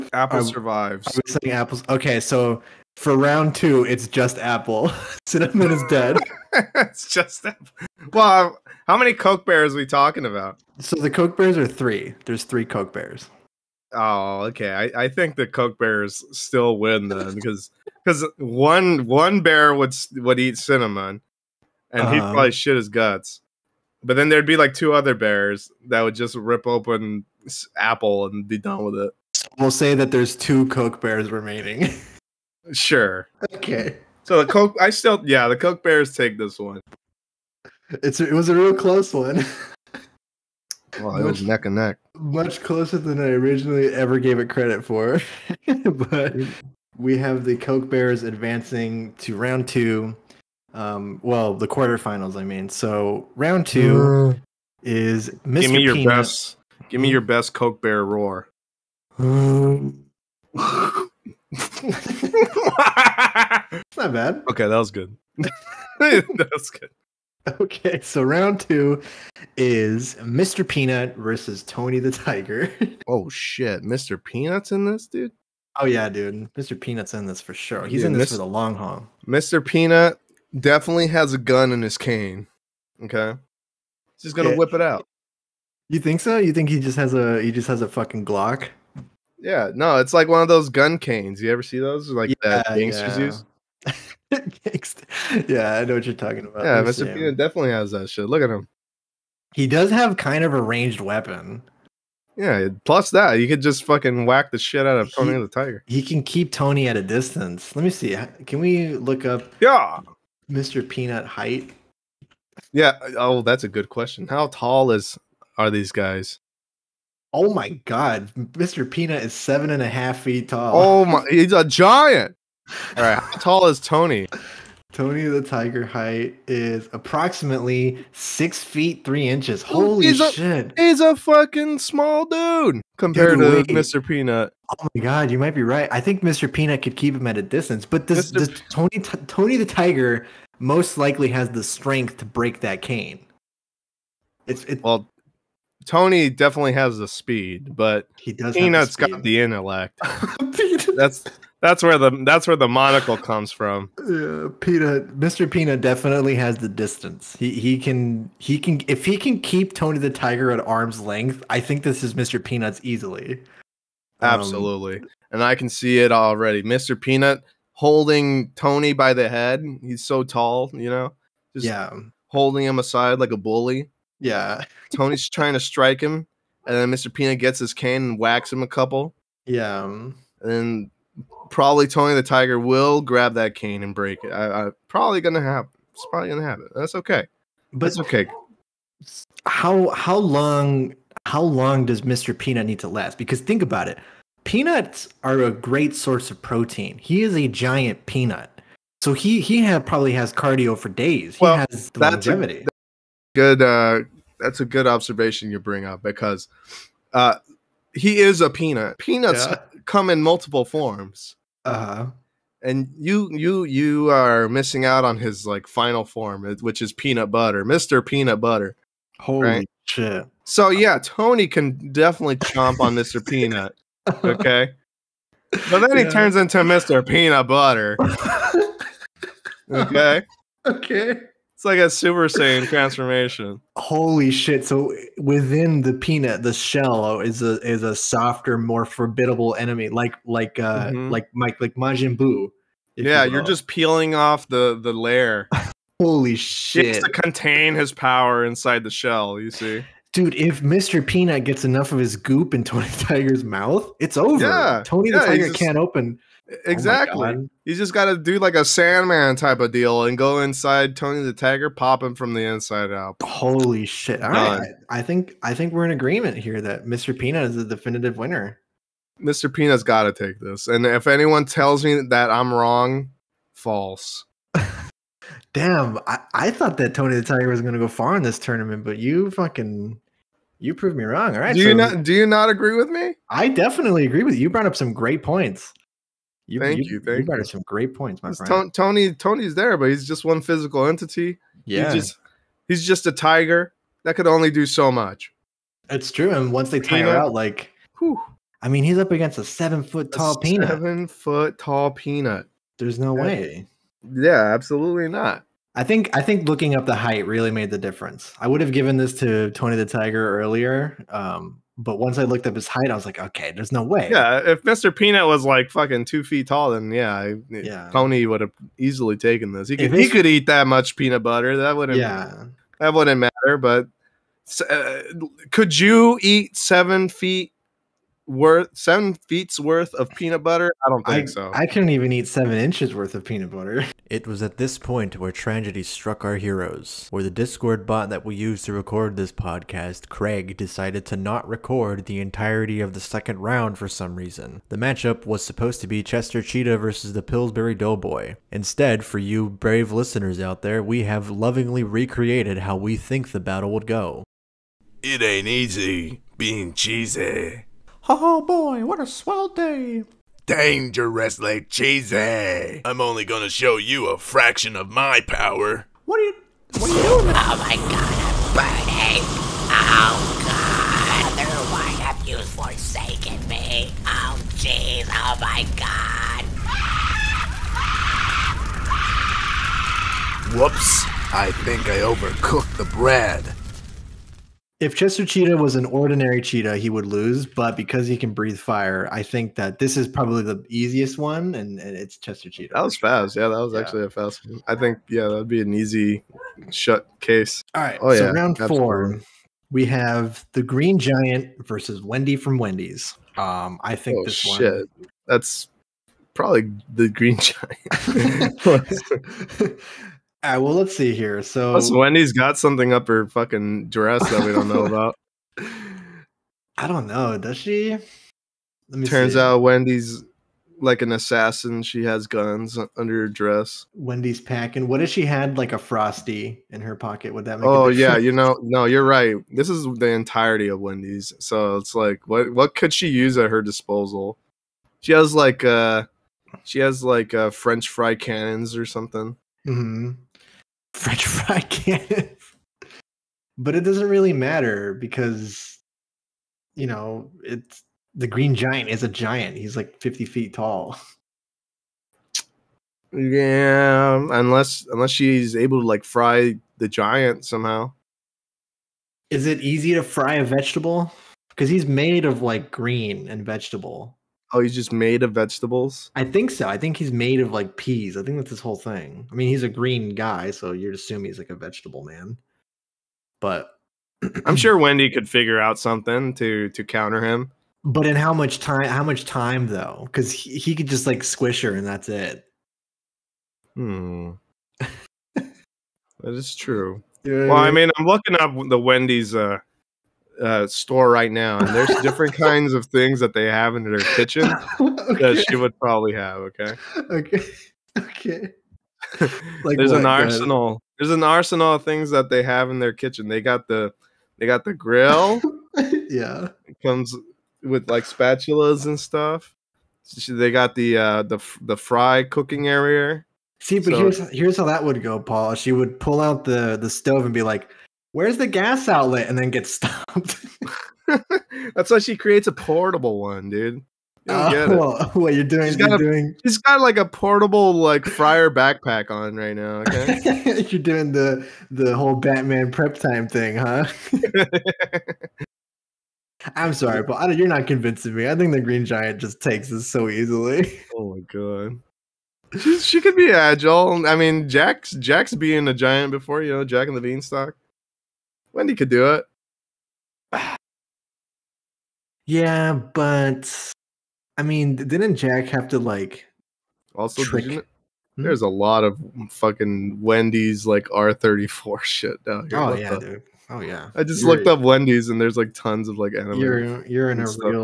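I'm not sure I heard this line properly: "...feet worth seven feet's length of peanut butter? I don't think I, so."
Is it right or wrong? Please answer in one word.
wrong.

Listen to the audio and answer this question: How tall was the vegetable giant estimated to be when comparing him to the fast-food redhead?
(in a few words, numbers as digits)
50 feet.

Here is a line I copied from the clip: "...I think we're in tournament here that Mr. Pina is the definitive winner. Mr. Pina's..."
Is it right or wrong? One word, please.
wrong.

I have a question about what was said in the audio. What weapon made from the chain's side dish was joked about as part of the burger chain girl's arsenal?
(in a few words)
French fry cannons.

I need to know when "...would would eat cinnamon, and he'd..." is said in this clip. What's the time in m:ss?
0:19.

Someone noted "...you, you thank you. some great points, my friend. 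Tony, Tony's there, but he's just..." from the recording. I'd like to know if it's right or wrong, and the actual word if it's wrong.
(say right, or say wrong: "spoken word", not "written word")
right.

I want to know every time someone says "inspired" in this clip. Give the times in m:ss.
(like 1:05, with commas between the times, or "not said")
not said.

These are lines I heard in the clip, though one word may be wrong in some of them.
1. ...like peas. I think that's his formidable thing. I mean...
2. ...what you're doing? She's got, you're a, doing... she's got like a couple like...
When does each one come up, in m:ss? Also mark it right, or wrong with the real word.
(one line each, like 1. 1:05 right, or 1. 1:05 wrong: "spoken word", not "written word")
1. 7:47 wrong: "whole", not "formidable"
2. 8:45 wrong: "portable", not "couple".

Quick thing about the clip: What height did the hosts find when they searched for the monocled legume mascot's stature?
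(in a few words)
7.5 feet.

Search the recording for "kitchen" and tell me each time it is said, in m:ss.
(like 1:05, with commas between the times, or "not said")
8:14, 8:22.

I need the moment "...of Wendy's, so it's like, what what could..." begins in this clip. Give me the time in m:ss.
7:10.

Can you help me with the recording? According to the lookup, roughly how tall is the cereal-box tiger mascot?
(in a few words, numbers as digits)
6 feet 3 inches.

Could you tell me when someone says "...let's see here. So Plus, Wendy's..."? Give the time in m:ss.
6:50.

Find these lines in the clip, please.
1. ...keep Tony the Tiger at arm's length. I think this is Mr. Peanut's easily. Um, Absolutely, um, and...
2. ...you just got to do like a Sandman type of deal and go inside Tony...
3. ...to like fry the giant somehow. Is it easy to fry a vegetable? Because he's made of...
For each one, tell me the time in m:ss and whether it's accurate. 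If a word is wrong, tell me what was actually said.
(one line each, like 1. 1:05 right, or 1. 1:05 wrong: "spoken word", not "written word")
1. 2:39 right
2. 4:17 right
3. 7:35 right.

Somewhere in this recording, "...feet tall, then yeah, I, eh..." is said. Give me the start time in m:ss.
5:16.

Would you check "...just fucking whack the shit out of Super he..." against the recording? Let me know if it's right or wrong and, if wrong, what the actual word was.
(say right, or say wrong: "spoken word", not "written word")
wrong: "Tony", not "Super".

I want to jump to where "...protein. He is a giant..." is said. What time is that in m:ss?
3:16.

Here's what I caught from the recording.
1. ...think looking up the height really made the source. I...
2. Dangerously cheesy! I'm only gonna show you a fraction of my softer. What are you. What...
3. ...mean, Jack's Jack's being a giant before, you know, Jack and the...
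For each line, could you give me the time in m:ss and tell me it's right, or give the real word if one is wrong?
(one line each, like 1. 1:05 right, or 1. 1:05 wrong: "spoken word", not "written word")
1. 5:06 wrong: "difference", not "source"
2. 6:00 wrong: "power", not "softer"
3. 9:04 right.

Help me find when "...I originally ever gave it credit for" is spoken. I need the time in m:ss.
0:43.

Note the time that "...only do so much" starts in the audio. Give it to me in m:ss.
4:54.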